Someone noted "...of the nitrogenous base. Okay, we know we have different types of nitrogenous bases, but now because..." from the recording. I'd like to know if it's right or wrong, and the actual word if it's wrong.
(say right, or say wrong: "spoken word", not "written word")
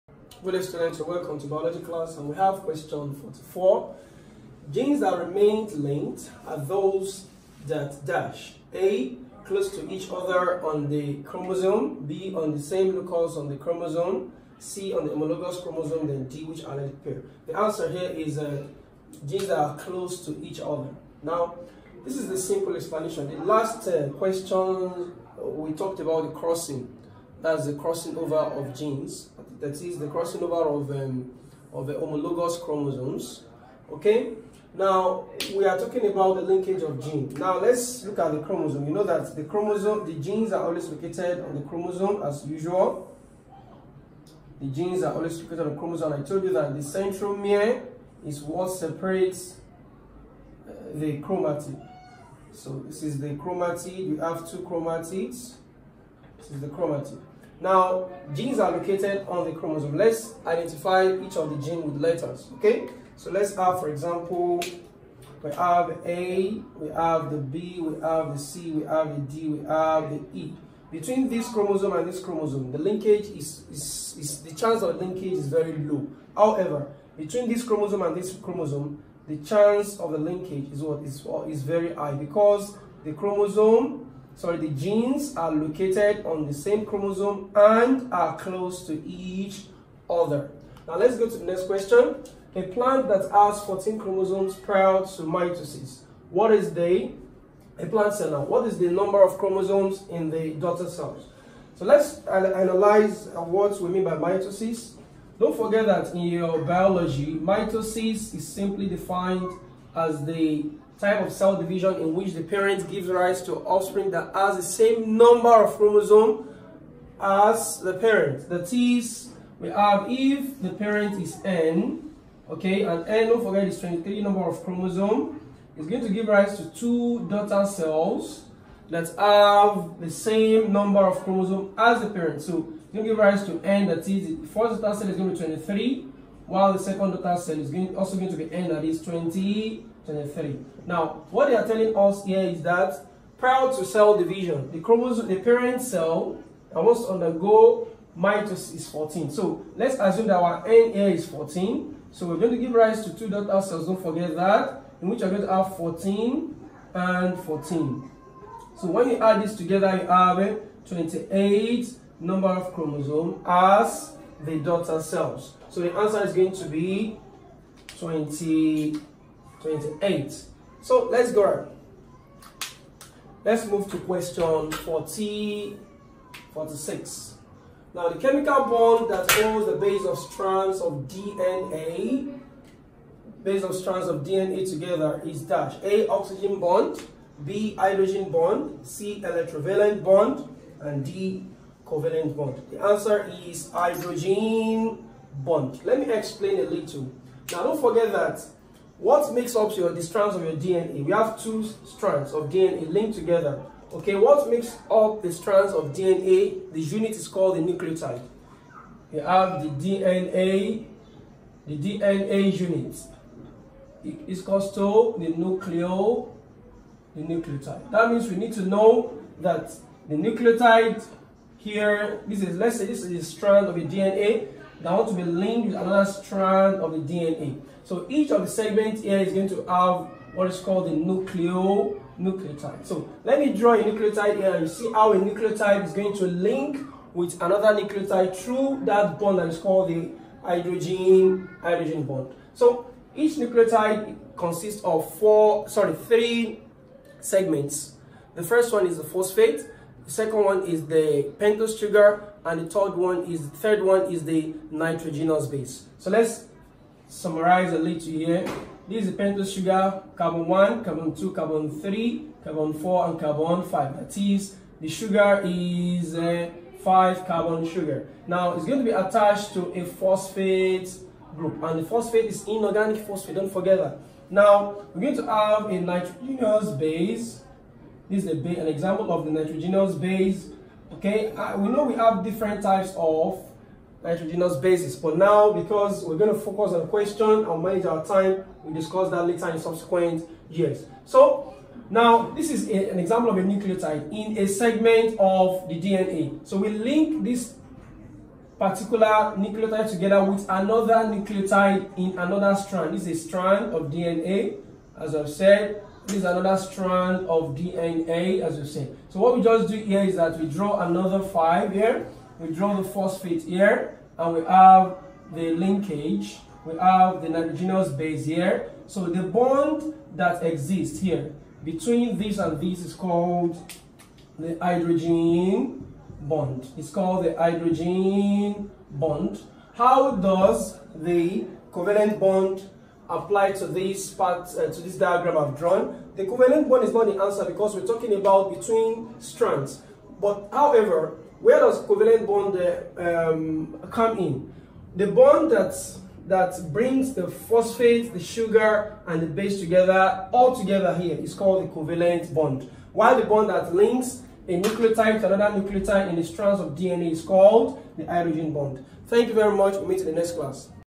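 right.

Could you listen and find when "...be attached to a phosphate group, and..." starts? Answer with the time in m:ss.
4:28.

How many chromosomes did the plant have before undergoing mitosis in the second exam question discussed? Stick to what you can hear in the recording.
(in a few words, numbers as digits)
14.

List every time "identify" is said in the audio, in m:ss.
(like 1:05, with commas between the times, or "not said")
1:00.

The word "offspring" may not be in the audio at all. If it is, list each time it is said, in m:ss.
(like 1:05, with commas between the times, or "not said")
1:53.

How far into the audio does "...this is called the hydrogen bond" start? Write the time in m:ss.
5:22.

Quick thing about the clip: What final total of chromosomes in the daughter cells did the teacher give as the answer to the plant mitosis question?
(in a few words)
28.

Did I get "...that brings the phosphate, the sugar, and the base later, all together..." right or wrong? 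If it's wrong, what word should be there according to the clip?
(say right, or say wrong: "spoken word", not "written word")
wrong: "together", not "later".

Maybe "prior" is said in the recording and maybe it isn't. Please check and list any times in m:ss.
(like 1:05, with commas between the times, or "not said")
1:34, 2:23.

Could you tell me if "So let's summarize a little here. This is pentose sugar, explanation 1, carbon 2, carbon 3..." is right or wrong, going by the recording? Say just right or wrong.
wrong.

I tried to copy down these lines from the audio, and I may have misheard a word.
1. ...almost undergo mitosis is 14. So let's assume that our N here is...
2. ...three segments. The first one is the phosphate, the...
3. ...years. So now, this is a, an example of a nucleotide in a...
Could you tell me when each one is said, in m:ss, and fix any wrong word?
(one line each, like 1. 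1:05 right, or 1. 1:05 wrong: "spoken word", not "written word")
1. 2:26 right
2. 4:05 right
3. 4:50 right.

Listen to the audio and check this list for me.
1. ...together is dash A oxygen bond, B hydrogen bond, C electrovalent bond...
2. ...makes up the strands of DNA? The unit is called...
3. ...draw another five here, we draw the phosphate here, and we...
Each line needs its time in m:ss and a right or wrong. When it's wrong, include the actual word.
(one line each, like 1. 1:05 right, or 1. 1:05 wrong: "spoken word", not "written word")
1. 3:04 right
2. 3:24 right
3. 5:10 right.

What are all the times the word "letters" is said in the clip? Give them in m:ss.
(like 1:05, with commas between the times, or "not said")
1:02.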